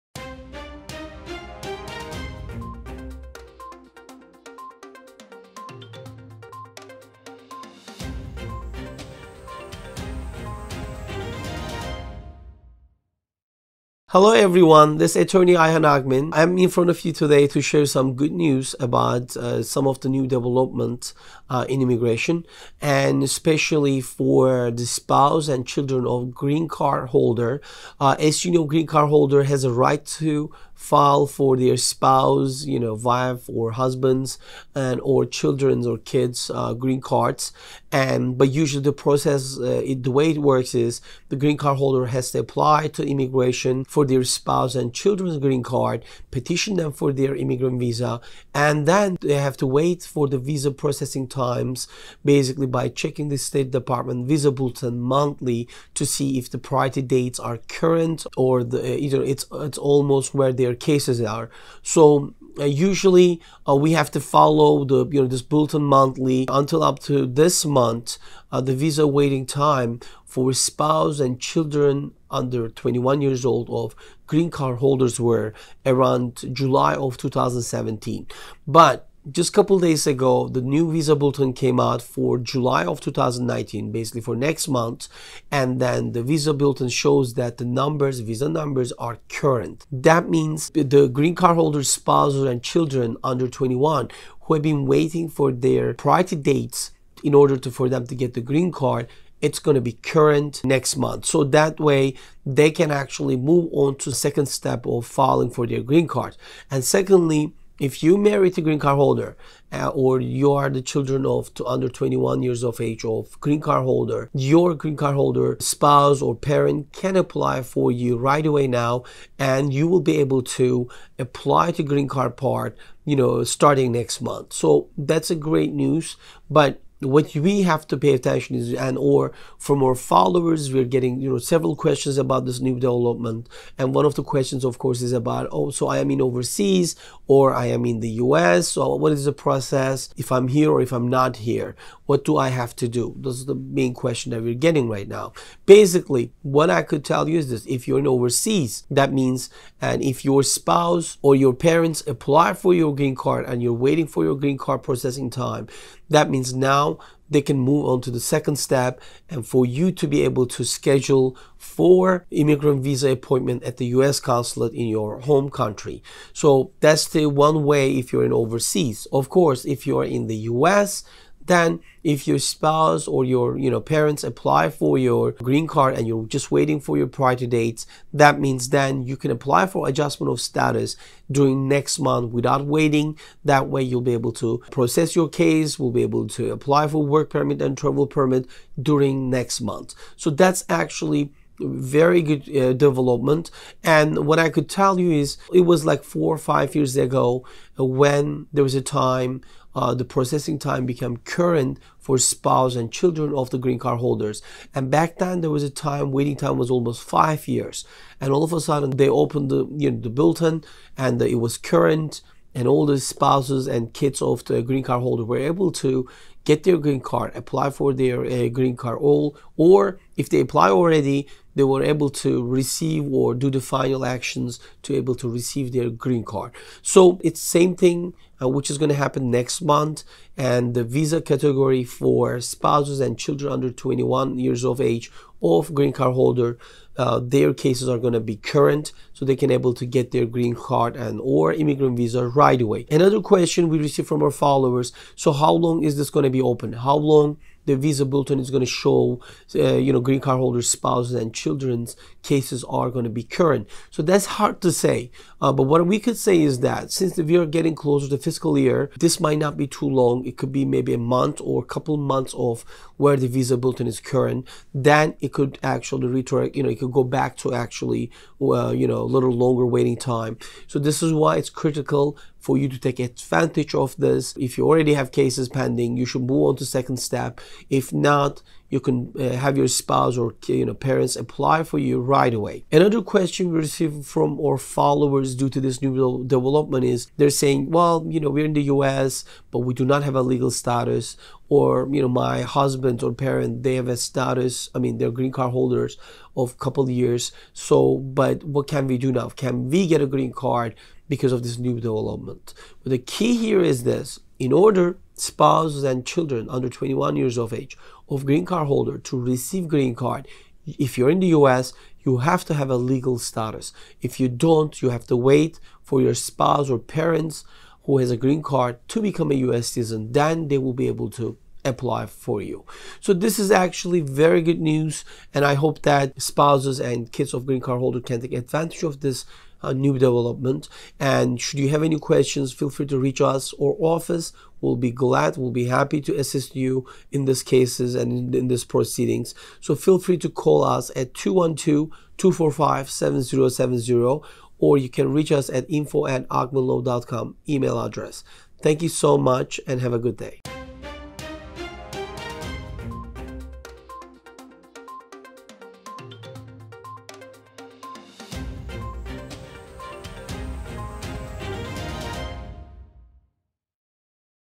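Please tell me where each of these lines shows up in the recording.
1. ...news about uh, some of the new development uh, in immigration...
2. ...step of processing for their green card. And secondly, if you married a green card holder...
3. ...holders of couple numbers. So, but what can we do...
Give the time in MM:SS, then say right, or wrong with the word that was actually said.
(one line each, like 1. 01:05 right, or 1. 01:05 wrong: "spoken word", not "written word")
1. 00:18 right
2. 01:44 wrong: "filing", not "processing"
3. 04:55 wrong: "years", not "numbers".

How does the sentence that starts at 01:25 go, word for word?
And then the visa bulletin shows that the numbers, visa numbers are current.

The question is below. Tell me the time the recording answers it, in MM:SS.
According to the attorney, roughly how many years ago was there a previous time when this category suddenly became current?
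03:16.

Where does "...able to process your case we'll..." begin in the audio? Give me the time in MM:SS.
03:04.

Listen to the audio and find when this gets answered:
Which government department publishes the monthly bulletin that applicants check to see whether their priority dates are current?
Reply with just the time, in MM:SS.
00:53.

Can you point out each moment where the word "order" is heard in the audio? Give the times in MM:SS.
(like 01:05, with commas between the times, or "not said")
01:37, 05:04.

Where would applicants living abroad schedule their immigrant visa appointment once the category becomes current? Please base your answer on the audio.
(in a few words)
US consulate.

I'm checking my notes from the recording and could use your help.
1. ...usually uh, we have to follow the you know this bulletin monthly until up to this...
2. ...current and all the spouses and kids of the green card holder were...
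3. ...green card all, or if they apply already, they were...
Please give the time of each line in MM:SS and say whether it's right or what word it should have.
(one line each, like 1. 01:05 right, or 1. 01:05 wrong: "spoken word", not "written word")
1. 01:02 right
2. 03:31 right
3. 03:38 right.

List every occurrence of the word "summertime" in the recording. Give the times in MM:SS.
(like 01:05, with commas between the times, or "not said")
not said.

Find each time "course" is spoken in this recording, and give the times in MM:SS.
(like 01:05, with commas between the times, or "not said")
02:14, 02:49.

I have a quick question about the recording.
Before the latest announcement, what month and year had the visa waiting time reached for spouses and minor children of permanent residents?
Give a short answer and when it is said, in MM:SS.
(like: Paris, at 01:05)
July 2017, at 01:16.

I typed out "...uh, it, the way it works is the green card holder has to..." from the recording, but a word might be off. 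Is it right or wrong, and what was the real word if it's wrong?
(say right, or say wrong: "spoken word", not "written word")
right.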